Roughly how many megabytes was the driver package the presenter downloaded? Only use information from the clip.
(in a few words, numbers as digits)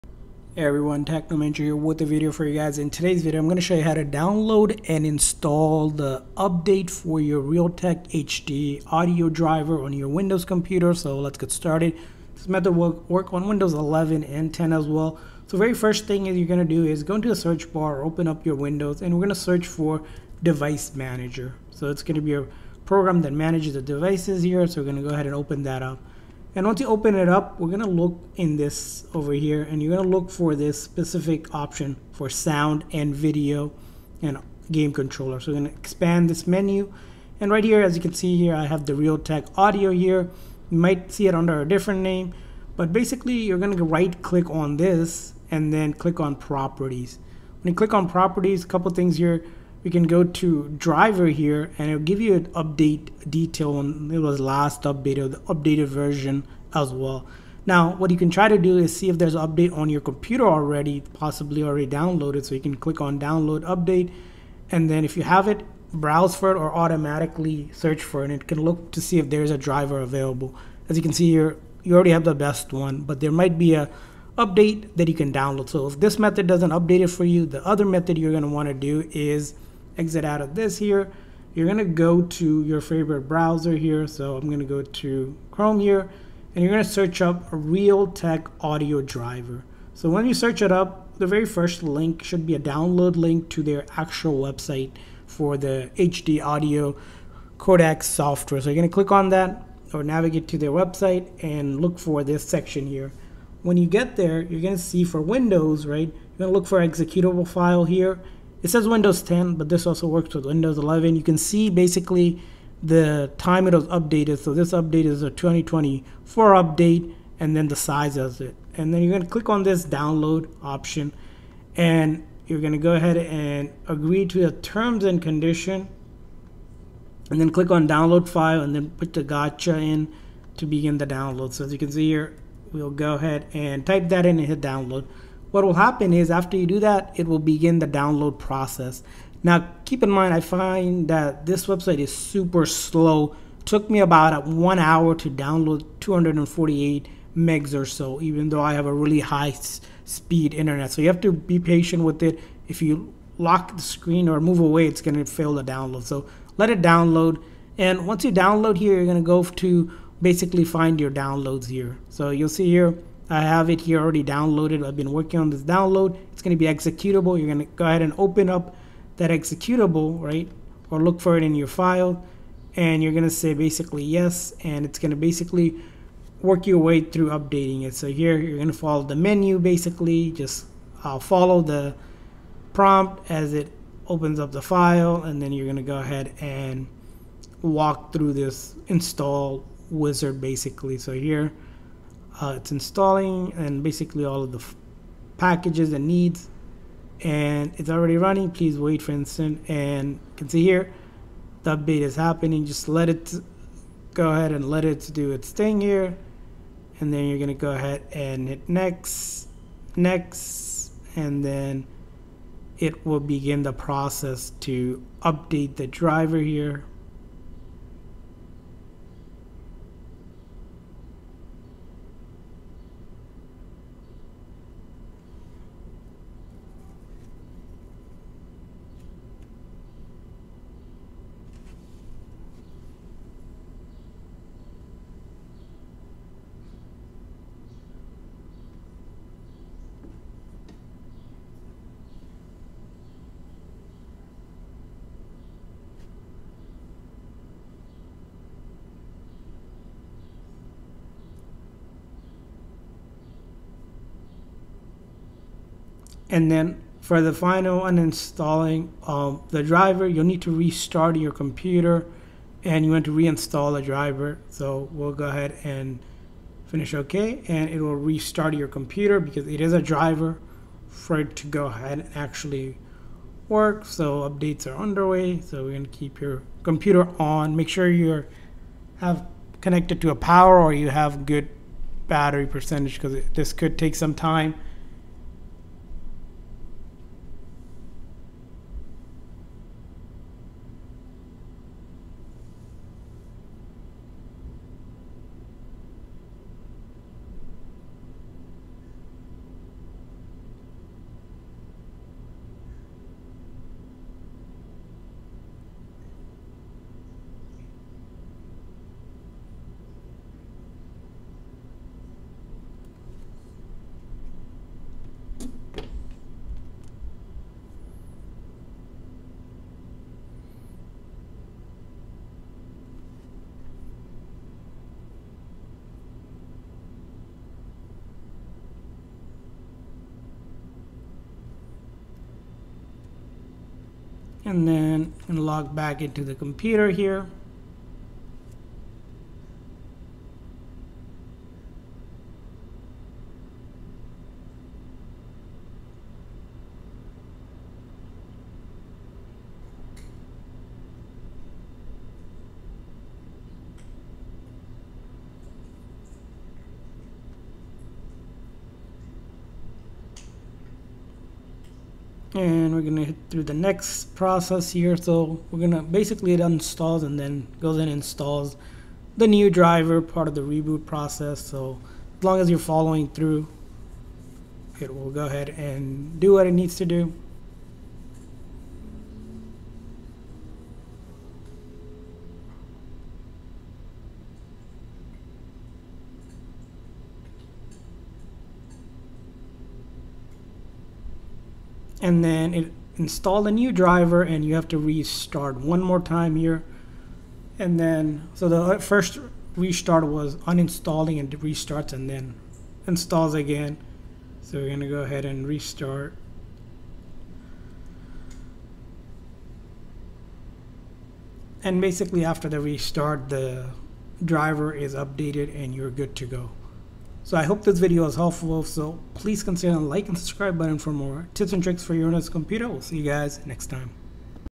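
248.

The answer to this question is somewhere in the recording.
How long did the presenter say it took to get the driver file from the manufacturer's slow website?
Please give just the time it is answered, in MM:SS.
02:24.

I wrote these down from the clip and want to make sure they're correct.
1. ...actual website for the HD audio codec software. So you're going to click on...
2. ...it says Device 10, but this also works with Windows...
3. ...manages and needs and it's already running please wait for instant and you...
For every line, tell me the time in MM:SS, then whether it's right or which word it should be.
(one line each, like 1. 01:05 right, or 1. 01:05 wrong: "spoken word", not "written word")
1. 01:33 right
2. 01:48 wrong: "Windows", not "Device"
3. 03:15 wrong: "packages", not "manages".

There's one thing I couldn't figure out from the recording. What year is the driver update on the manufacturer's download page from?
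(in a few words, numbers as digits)
2024.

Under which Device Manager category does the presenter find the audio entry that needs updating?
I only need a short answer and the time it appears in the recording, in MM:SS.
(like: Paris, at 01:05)
Sound and video and game controller, at 00:32.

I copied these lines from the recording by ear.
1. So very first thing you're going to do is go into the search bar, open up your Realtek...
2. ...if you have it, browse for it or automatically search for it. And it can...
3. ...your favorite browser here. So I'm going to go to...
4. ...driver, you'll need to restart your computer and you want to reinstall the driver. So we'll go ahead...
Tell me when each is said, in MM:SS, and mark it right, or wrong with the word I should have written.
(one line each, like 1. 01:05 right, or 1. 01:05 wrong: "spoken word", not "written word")
1. 00:15 wrong: "Windows", not "Realtek"
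2. 01:05 right
3. 01:22 right
4. 04:19 right.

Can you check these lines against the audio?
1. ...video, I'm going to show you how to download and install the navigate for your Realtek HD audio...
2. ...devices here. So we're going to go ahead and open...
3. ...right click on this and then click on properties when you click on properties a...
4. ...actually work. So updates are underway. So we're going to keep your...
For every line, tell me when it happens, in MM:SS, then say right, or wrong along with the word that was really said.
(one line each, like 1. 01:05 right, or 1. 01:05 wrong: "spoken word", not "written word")
1. 00:03 wrong: "update", not "navigate"
2. 00:23 right
3. 00:43 right
4. 04:32 right.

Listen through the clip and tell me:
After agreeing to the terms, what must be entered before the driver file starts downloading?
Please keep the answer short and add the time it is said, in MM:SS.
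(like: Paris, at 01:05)
Captcha, at 02:09.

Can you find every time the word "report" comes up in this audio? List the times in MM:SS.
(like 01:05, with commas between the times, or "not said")
not said.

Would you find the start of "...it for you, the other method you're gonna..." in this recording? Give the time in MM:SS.
01:17.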